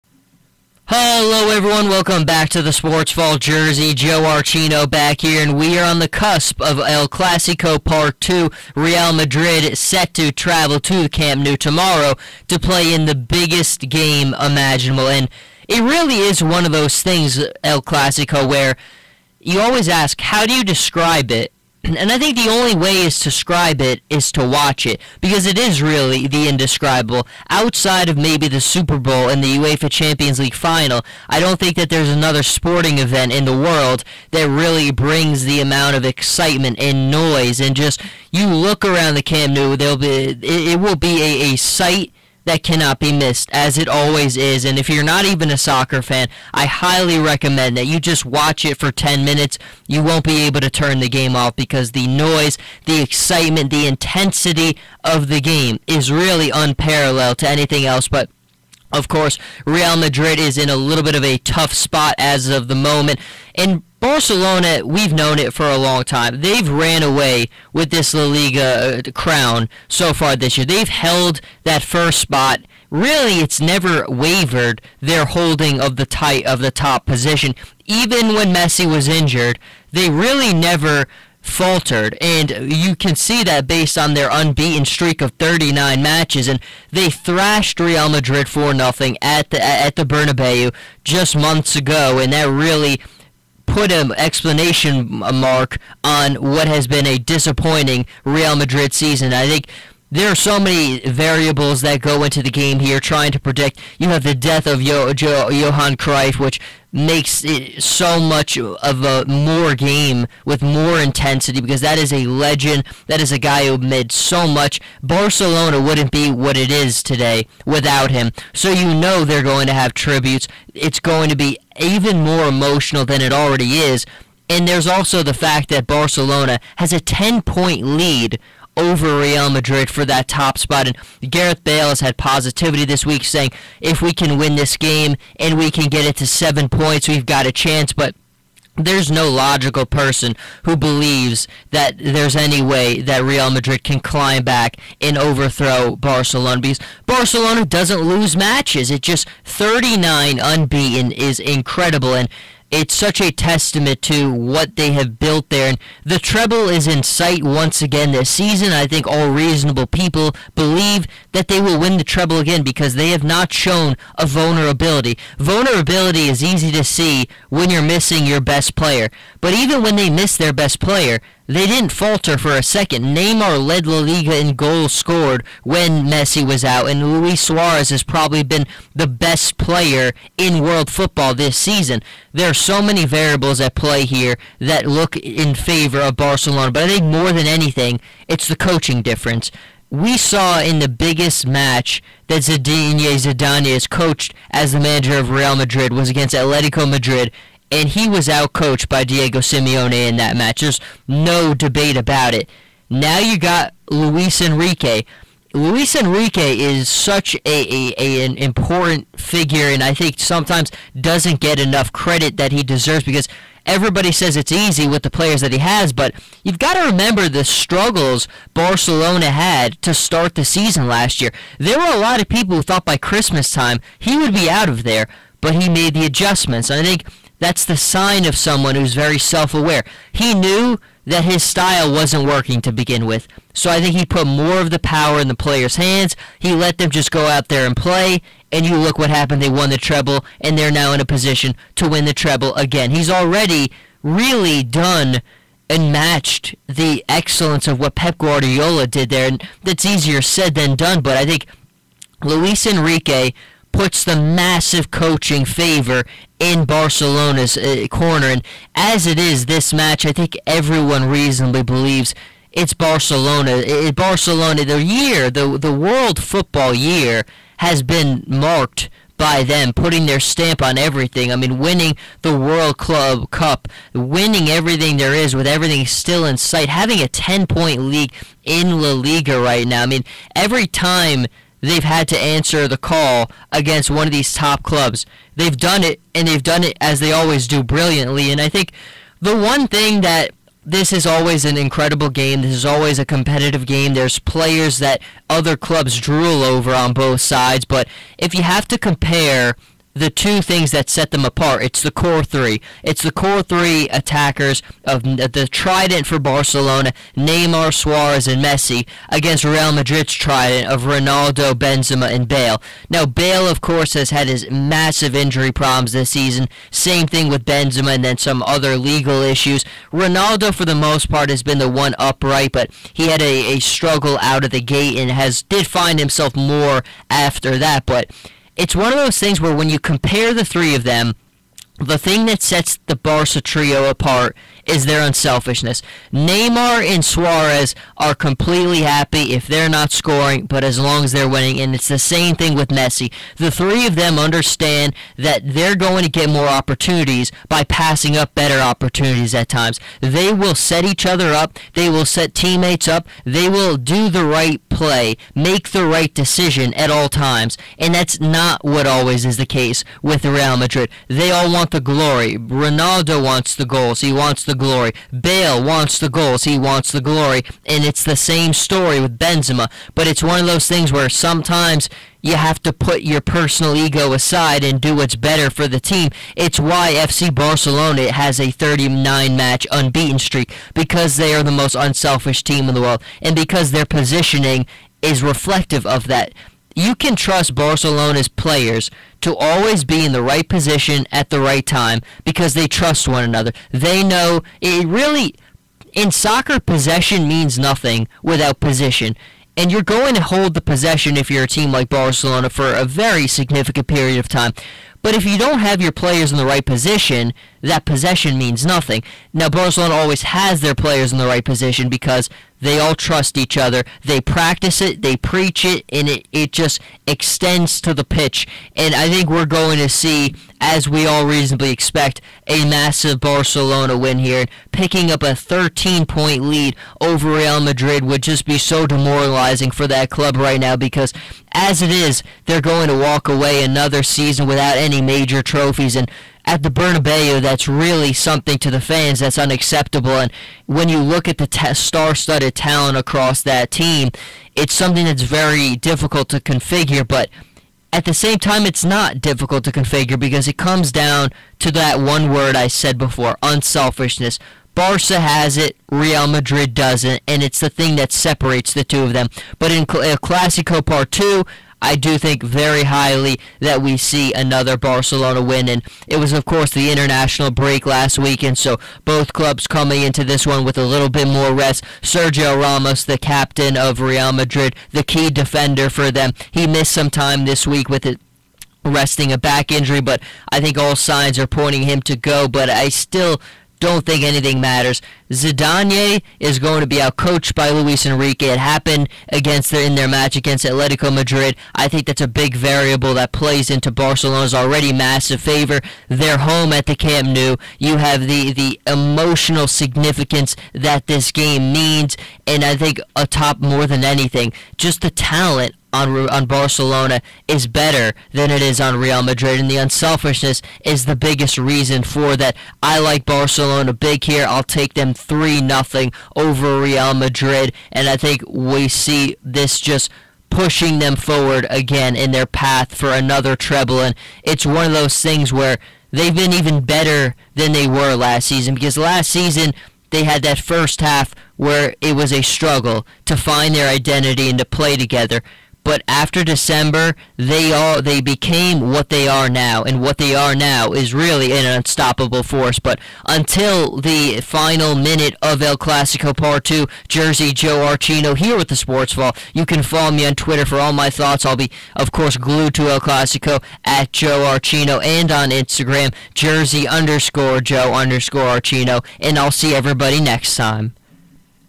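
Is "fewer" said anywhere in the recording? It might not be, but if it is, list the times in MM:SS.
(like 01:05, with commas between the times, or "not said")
not said.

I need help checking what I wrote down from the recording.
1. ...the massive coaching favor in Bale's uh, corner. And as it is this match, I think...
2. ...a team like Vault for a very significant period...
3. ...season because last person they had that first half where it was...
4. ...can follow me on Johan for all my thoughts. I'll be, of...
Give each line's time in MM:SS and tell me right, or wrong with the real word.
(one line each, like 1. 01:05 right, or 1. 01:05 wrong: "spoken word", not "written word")
1. 04:14 wrong: "Barcelona", not "Bale"
2. 06:41 wrong: "Barcelona", not "Vault"
3. 08:48 wrong: "season", not "person"
4. 09:09 wrong: "Twitter", not "Johan".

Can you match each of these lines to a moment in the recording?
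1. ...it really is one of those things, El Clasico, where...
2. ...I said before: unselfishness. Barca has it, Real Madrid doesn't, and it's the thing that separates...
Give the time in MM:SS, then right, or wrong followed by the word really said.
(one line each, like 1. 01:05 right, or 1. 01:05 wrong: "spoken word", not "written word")
1. 00:15 right
2. 07:32 right.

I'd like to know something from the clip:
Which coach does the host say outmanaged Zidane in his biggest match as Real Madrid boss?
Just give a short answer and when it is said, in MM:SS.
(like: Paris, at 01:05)
Diego Simeone, at 03:19.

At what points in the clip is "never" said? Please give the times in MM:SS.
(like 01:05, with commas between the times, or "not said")
01:13, 01:20.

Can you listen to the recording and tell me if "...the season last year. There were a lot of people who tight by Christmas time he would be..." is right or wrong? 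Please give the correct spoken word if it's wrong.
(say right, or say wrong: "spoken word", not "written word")
wrong: "thought", not "tight".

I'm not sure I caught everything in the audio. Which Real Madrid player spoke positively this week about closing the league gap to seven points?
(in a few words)
Gareth Bale.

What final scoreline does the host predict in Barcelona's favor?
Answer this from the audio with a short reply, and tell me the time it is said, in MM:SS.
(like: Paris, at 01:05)
3-0, at 08:35.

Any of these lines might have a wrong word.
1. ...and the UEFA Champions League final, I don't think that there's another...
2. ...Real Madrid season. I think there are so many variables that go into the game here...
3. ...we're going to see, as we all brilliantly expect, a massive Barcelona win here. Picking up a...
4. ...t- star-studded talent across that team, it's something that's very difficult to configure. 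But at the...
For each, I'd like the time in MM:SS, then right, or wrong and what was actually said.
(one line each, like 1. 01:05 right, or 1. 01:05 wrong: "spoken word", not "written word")
1. 00:29 right
2. 01:38 right
3. 06:59 wrong: "reasonably", not "brilliantly"
4. 07:21 right.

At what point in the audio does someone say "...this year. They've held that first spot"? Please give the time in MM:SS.
01:10.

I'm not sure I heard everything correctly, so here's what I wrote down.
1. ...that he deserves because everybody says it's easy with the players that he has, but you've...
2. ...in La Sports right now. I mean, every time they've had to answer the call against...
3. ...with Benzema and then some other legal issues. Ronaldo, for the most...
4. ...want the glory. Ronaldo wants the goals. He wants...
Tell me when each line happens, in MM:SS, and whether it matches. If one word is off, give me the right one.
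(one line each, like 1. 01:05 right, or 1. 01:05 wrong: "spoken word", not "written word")
1. 03:32 right
2. 04:38 wrong: "Liga", not "Sports"
3. 05:17 right
4. 06:01 right.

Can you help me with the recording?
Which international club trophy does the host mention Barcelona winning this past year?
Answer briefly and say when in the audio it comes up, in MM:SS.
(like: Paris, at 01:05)
World Club Cup, at 04:32.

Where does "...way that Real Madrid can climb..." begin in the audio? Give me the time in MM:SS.
02:22.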